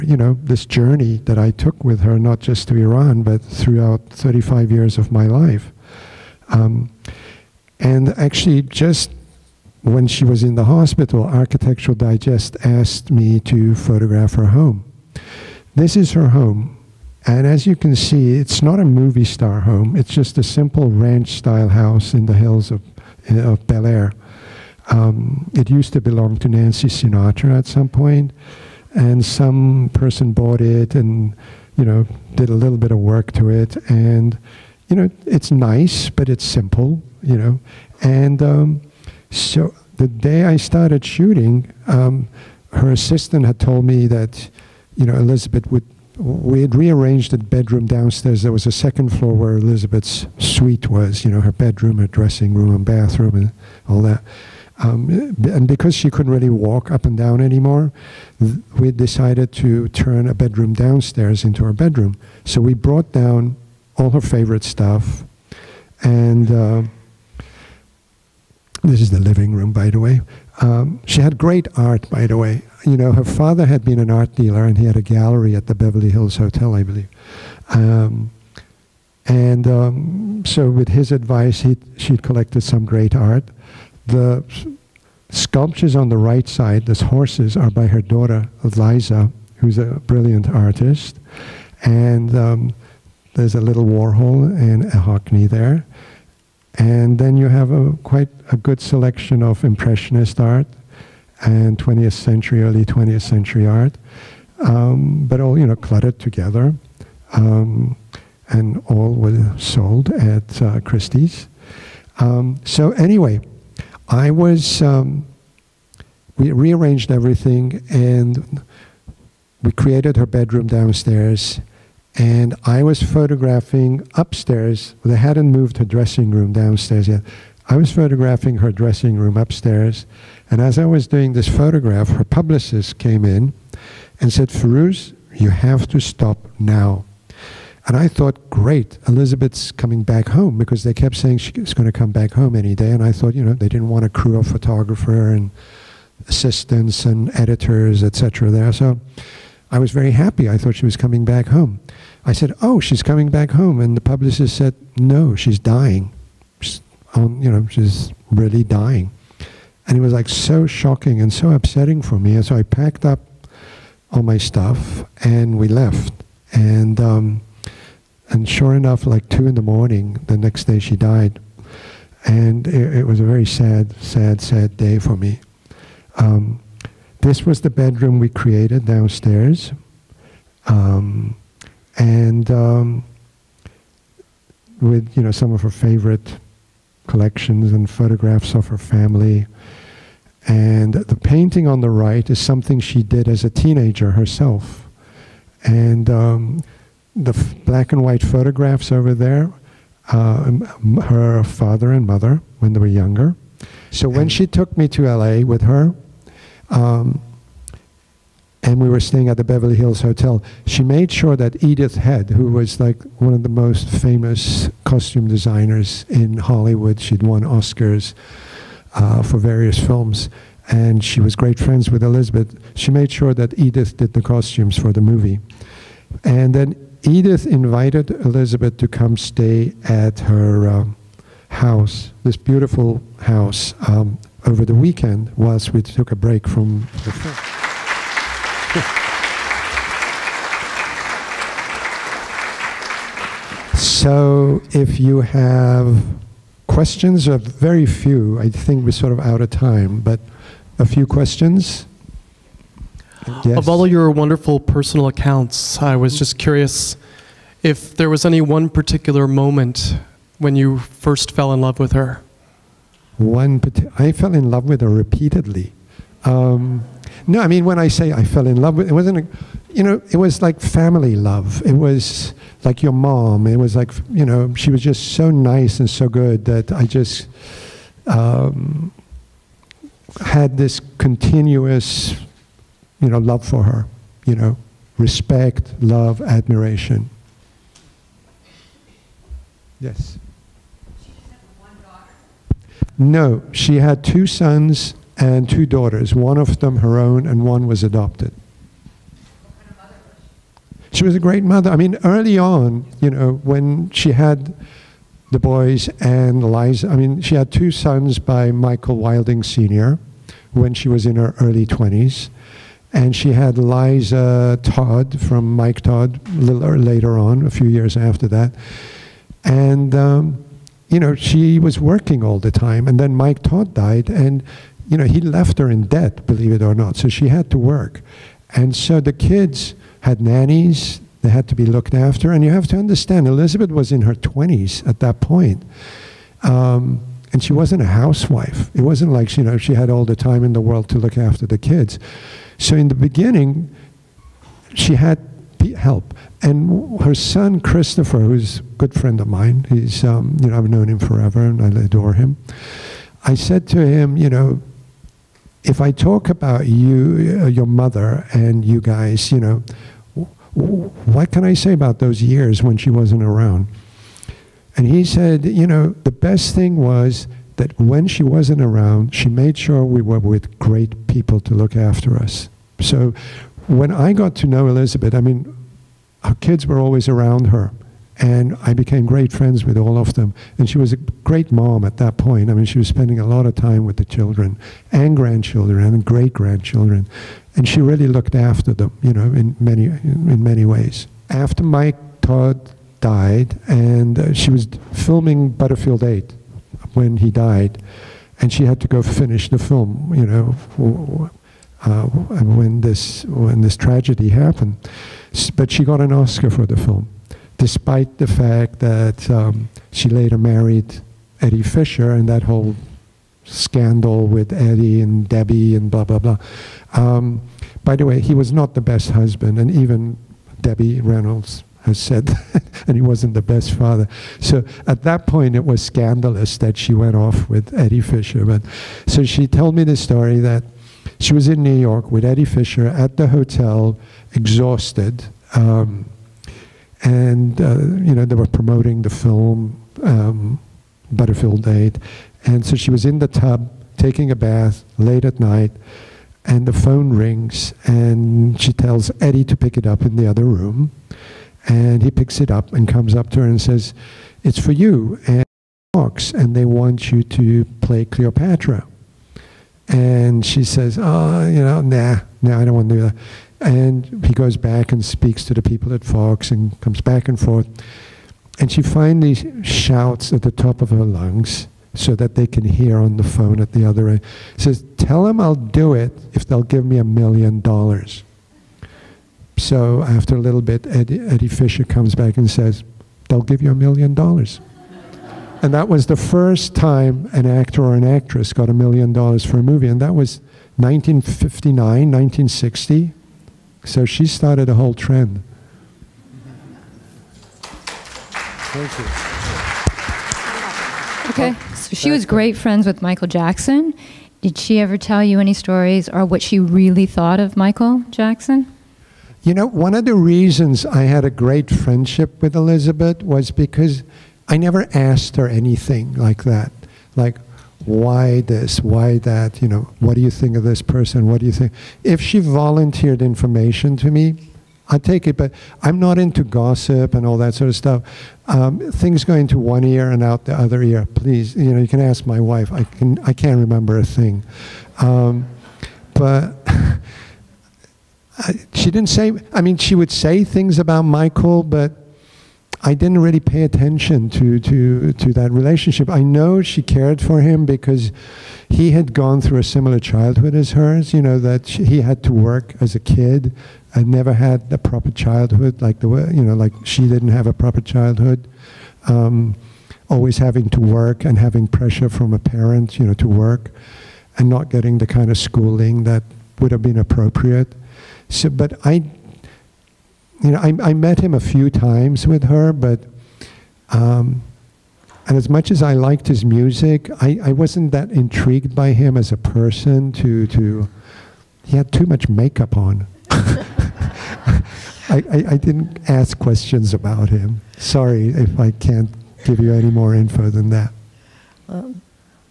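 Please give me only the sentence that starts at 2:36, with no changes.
She's you know, she's really dying." And it was like so shocking and so upsetting for me.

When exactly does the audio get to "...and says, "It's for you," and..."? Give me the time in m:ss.
7:33.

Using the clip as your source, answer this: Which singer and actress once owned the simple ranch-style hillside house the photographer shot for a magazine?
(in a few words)
Nancy Sinatra.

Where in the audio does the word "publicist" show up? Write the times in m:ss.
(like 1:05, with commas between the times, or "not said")
2:12, 2:34.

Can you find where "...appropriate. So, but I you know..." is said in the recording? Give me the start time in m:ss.
9:26.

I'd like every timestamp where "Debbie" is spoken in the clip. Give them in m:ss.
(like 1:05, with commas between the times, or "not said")
6:55, 7:00.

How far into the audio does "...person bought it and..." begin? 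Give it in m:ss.
0:29.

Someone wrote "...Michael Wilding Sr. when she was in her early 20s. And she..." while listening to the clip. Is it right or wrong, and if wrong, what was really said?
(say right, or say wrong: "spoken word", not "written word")
right.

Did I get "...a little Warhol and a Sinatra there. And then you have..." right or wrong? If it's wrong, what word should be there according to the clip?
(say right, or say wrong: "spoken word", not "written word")
wrong: "Hockney", not "Sinatra".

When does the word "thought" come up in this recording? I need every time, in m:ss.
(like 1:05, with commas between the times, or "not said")
2:18, 2:23, 2:30, 8:27.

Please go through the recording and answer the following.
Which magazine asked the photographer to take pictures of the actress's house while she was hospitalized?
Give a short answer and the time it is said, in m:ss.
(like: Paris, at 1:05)
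Architectural Digest, at 0:11.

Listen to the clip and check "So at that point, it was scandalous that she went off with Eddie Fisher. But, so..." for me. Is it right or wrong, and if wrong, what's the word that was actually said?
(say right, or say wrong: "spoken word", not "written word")
right.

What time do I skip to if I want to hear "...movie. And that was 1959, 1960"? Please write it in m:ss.
8:09.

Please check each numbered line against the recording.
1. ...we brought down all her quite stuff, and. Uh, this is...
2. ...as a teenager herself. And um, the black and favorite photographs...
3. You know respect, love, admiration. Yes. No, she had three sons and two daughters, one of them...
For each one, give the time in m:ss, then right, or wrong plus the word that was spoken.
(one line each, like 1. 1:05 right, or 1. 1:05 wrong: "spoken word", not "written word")
1. 1:02 wrong: "favorite", not "quite"
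2. 3:13 wrong: "white", not "favorite"
3. 4:44 wrong: "two", not "three".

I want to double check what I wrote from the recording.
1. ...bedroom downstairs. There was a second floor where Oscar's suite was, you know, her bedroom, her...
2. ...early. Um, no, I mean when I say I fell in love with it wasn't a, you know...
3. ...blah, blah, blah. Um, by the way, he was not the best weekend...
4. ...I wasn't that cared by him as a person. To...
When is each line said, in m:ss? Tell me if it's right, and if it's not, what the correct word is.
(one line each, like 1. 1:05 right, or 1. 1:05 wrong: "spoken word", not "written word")
1. 0:47 wrong: "Elizabeth", not "Oscar"
2. 4:24 wrong: "repeatedly", not "early"
3. 6:55 wrong: "husband", not "weekend"
4. 9:37 wrong: "intrigued", not "cared".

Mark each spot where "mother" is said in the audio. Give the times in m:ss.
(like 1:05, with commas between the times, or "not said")
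3:22, 5:01, 5:57.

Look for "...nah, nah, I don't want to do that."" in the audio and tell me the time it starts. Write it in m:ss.
7:41.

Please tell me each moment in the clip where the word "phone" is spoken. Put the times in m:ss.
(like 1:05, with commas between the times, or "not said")
7:26, 7:53.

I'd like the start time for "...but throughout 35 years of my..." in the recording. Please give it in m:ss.
0:03.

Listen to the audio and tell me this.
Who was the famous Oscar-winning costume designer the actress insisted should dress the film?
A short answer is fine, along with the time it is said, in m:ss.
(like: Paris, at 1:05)
Edith Head, at 3:31.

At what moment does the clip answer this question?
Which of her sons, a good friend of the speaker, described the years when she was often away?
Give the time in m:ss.
5:47.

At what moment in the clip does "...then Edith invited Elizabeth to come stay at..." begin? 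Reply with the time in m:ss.
3:46.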